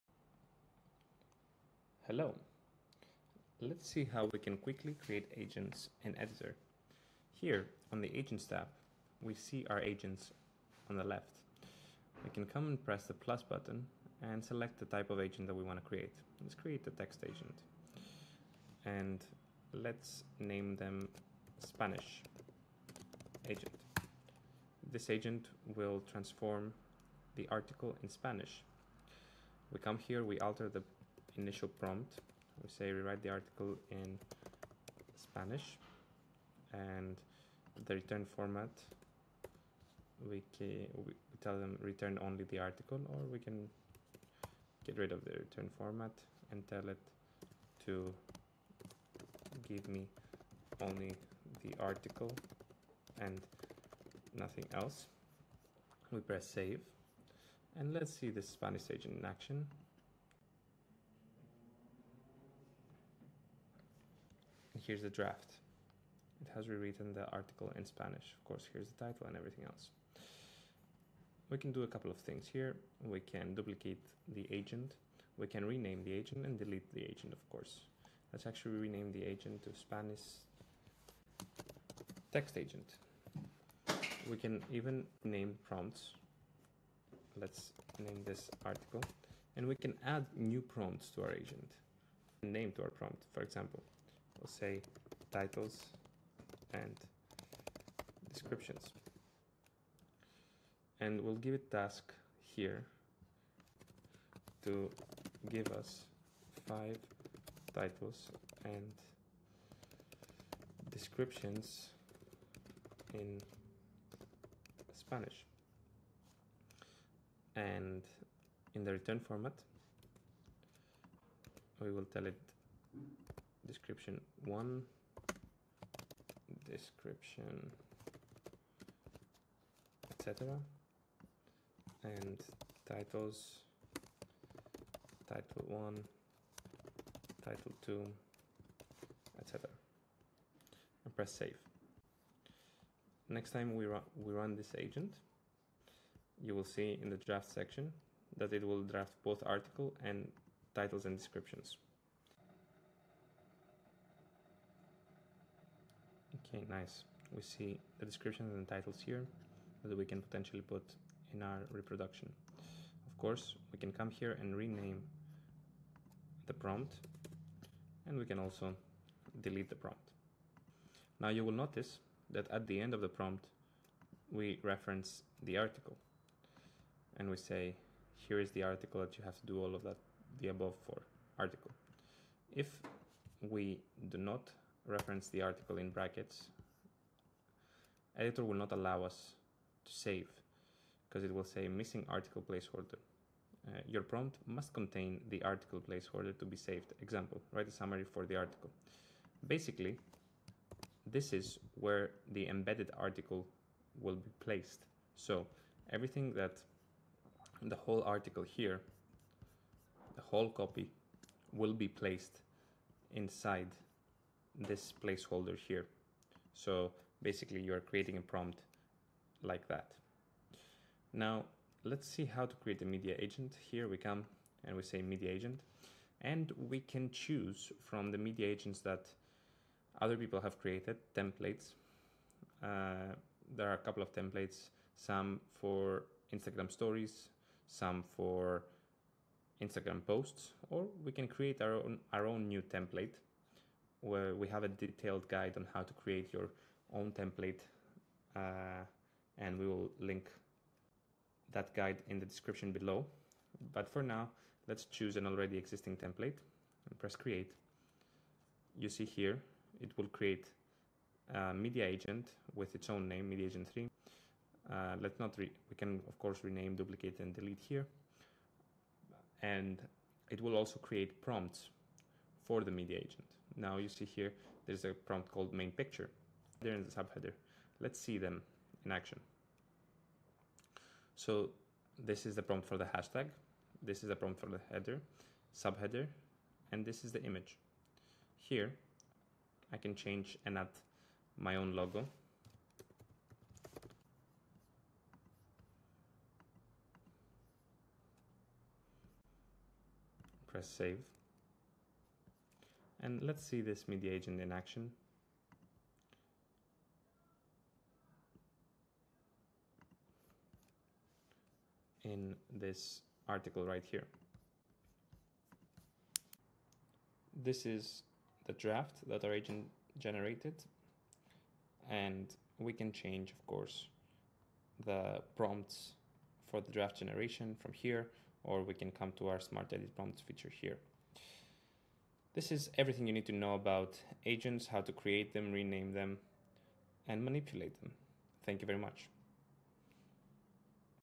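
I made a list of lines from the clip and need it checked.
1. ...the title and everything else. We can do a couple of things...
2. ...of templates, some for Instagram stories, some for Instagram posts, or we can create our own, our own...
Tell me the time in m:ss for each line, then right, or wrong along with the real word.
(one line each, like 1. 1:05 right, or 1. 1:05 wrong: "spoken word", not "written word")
1. 1:08 right
2. 3:54 right.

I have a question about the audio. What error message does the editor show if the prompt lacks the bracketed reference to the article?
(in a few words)
missing article placeholder.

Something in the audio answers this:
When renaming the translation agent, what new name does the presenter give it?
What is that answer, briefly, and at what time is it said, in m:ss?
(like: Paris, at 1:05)
Spanish text agent, at 1:19.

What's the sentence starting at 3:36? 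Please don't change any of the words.
So basically you're creating a prompt like that.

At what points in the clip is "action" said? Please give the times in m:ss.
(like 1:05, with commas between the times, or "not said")
0:59, 4:38, 5:04.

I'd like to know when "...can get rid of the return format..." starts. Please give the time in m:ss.
0:43.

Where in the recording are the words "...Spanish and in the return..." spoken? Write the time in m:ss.
1:54.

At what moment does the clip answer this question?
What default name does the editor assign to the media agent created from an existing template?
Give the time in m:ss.
4:23.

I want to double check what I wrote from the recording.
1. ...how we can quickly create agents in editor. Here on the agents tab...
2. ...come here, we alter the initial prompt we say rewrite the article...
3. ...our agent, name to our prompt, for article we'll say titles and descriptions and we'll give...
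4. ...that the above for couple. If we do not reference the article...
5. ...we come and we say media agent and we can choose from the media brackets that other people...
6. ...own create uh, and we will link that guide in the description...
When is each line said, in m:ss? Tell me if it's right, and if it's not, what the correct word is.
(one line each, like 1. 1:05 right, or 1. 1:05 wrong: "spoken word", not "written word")
1. 0:04 right
2. 0:29 right
3. 1:31 wrong: "example", not "article"
4. 2:59 wrong: "article", not "couple"
5. 3:43 wrong: "agents", not "brackets"
6. 4:06 wrong: "template", not "create".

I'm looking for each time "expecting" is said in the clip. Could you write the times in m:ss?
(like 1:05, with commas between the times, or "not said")
not said.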